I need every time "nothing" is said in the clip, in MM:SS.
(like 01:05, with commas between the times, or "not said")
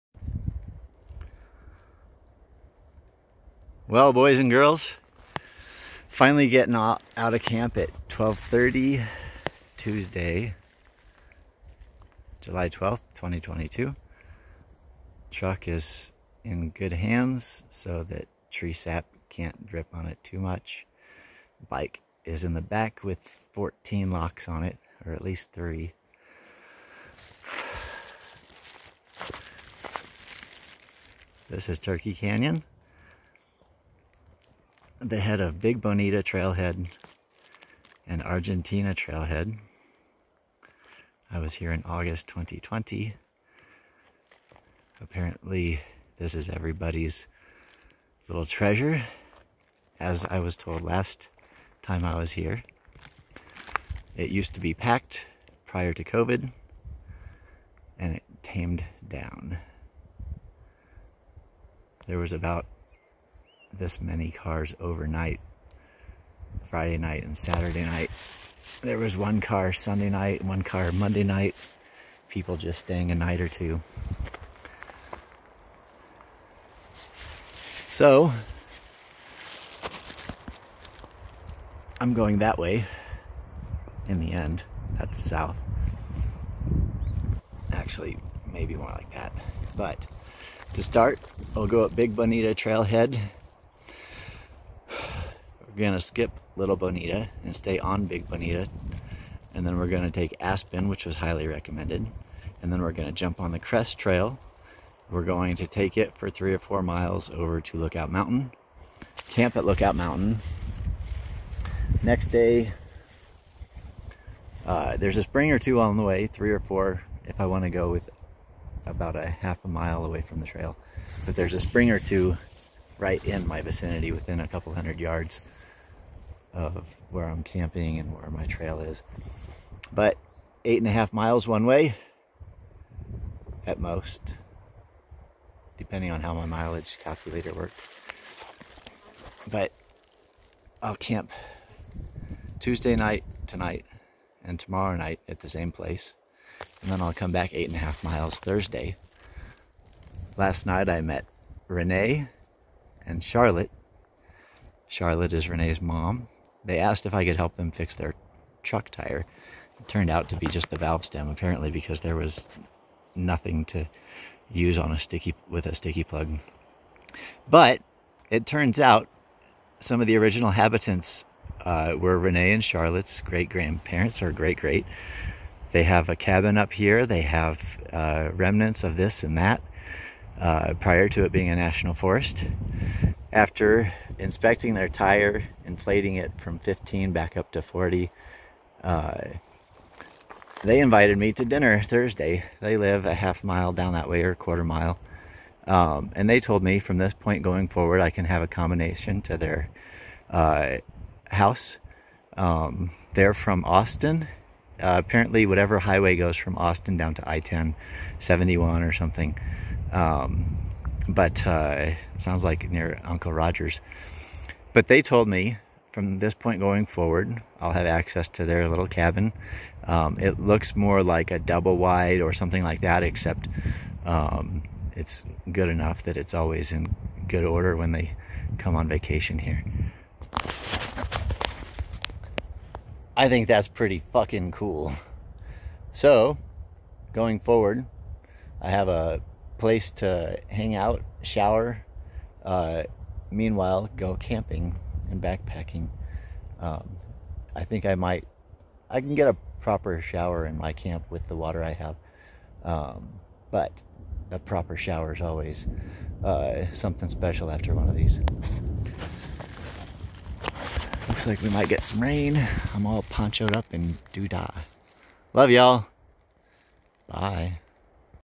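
02:43.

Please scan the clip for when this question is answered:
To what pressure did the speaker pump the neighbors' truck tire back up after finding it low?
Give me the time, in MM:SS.
03:07.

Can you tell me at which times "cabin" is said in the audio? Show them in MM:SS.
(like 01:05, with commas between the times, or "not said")
02:56, 03:38.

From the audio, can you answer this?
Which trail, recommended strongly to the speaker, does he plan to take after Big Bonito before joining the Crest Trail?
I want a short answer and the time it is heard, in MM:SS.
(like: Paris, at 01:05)
Aspen, at 01:40.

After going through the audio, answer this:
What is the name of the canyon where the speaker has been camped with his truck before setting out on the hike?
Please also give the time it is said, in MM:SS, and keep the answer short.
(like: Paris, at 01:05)
Turkey Canyon, at 00:31.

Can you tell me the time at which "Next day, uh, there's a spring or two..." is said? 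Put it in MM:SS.
01:52.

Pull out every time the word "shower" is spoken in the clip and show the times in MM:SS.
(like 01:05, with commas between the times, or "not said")
04:01, 04:10, 04:14.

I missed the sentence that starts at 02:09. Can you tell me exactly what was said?
But eight and a half miles one way at most, depending on how my mileage calculator worked.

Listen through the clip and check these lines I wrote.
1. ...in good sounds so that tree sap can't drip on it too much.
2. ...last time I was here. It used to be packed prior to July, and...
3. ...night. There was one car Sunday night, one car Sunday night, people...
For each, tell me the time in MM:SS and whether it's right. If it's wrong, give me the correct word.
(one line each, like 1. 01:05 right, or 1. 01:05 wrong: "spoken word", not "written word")
1. 00:16 wrong: "hands", not "sounds"
2. 00:50 wrong: "COVID", not "July"
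3. 01:07 wrong: "Monday", not "Sunday".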